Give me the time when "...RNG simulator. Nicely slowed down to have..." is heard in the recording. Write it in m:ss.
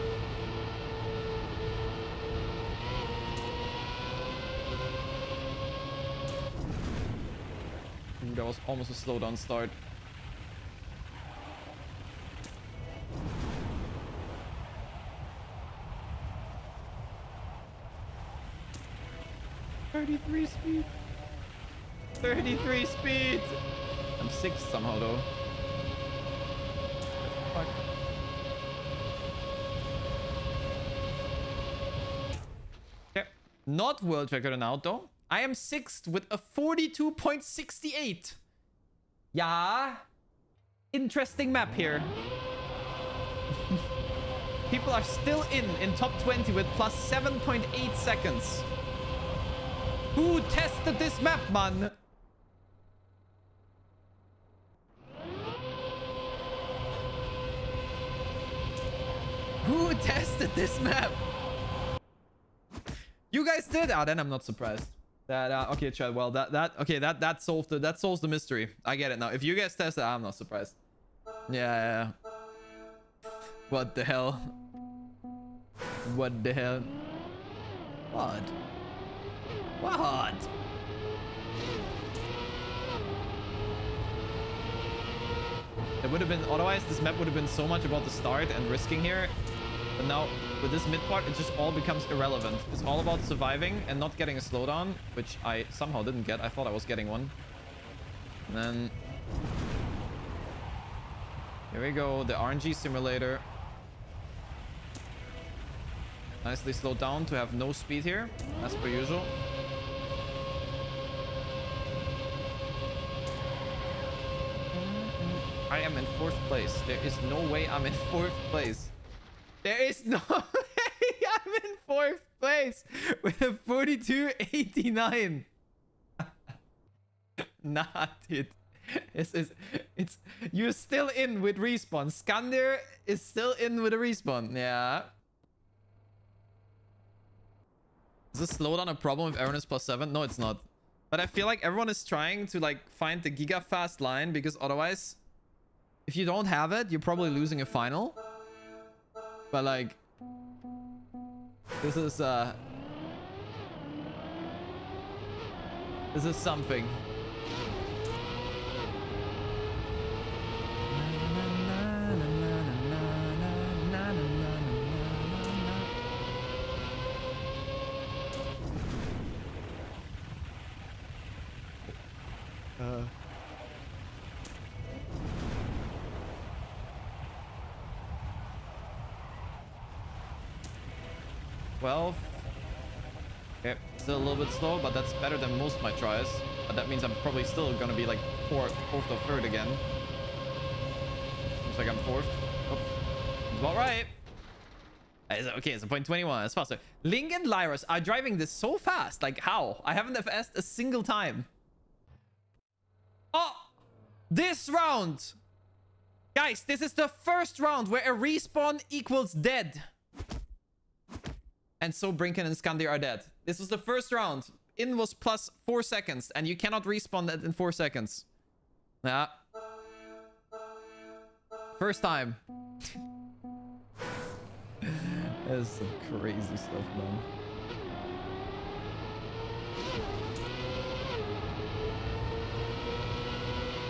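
1:42.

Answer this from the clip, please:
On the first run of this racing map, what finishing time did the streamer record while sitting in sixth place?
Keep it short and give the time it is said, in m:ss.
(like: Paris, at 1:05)
42.68, at 0:36.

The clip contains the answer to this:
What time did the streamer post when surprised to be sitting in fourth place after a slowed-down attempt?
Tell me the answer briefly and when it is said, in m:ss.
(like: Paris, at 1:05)
42.89, at 2:03.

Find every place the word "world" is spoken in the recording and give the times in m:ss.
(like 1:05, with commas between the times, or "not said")
0:34.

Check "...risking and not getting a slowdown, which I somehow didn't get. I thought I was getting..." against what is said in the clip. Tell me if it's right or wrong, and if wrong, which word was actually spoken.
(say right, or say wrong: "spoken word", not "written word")
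wrong: "surviving", not "risking".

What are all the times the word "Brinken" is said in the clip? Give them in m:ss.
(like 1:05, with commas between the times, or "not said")
3:32.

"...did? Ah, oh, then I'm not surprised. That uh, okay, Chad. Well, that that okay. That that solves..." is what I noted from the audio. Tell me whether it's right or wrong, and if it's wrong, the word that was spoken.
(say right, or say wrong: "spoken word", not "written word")
right.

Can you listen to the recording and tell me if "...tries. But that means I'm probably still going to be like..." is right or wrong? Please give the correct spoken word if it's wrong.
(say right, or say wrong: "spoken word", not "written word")
right.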